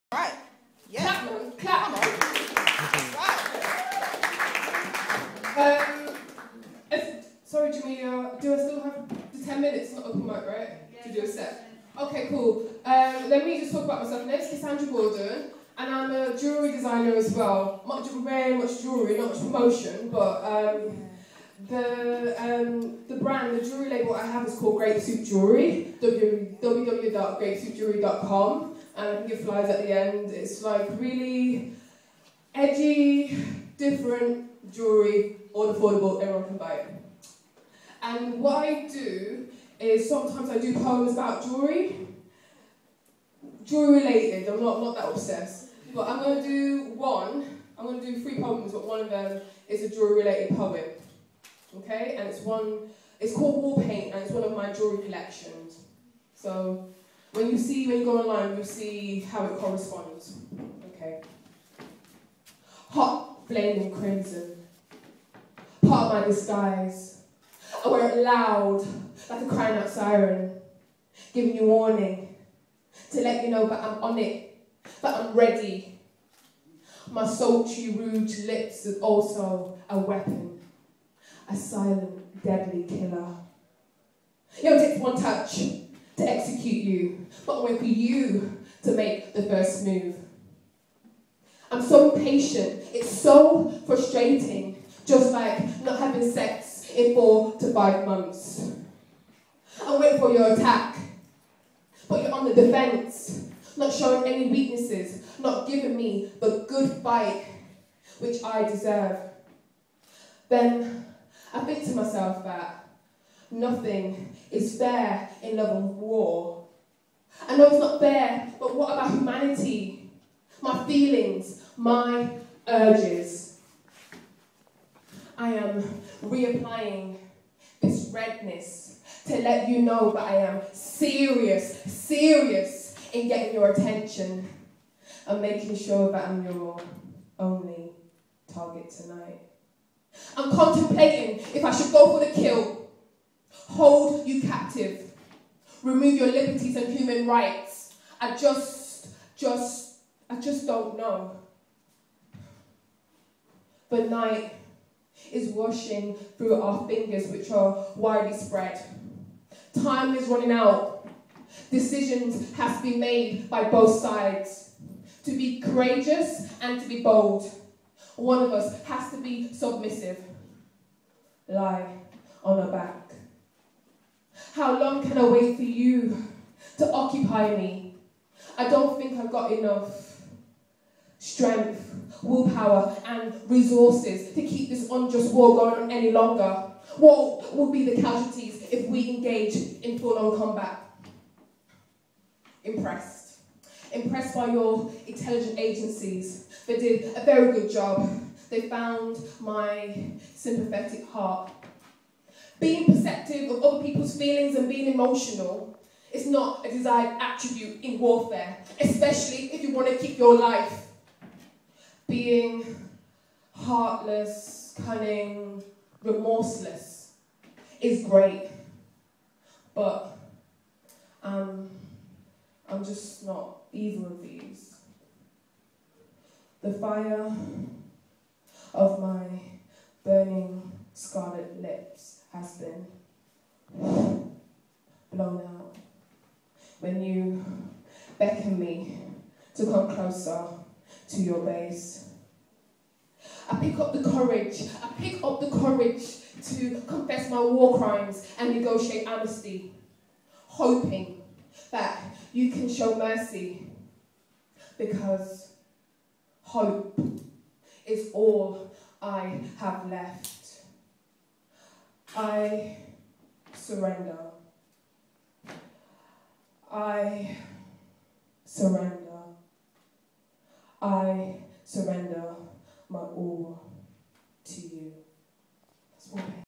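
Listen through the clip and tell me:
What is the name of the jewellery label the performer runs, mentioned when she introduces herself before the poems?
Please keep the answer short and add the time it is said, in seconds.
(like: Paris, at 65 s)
Grape Soup Jewellery, at 24 s.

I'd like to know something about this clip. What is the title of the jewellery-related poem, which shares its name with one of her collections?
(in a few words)
Wall Paint.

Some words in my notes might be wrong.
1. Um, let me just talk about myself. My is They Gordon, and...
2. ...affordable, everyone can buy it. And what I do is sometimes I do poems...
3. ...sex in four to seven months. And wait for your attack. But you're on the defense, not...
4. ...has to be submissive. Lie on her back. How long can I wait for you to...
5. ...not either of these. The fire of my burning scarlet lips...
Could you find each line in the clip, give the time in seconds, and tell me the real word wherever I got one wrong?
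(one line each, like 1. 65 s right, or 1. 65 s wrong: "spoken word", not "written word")
1. 12 s wrong: "Kassandra", not "They"
2. 35 s right
3. 96 s wrong: "five", not "seven"
4. 168 s right
5. 223 s right.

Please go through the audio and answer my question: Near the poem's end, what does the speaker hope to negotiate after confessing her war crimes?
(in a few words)
amnesty.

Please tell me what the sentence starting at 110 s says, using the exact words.
Then I think to myself that nothing is fair in love and war.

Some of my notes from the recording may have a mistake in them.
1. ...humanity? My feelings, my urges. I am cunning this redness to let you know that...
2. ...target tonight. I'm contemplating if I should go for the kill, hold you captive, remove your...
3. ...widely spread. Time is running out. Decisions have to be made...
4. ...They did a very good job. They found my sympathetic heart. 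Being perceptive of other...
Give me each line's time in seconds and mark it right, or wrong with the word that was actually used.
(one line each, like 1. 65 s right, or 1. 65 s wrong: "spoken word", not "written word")
1. 119 s wrong: "reapplying", not "cunning"
2. 138 s right
3. 157 s right
4. 196 s right.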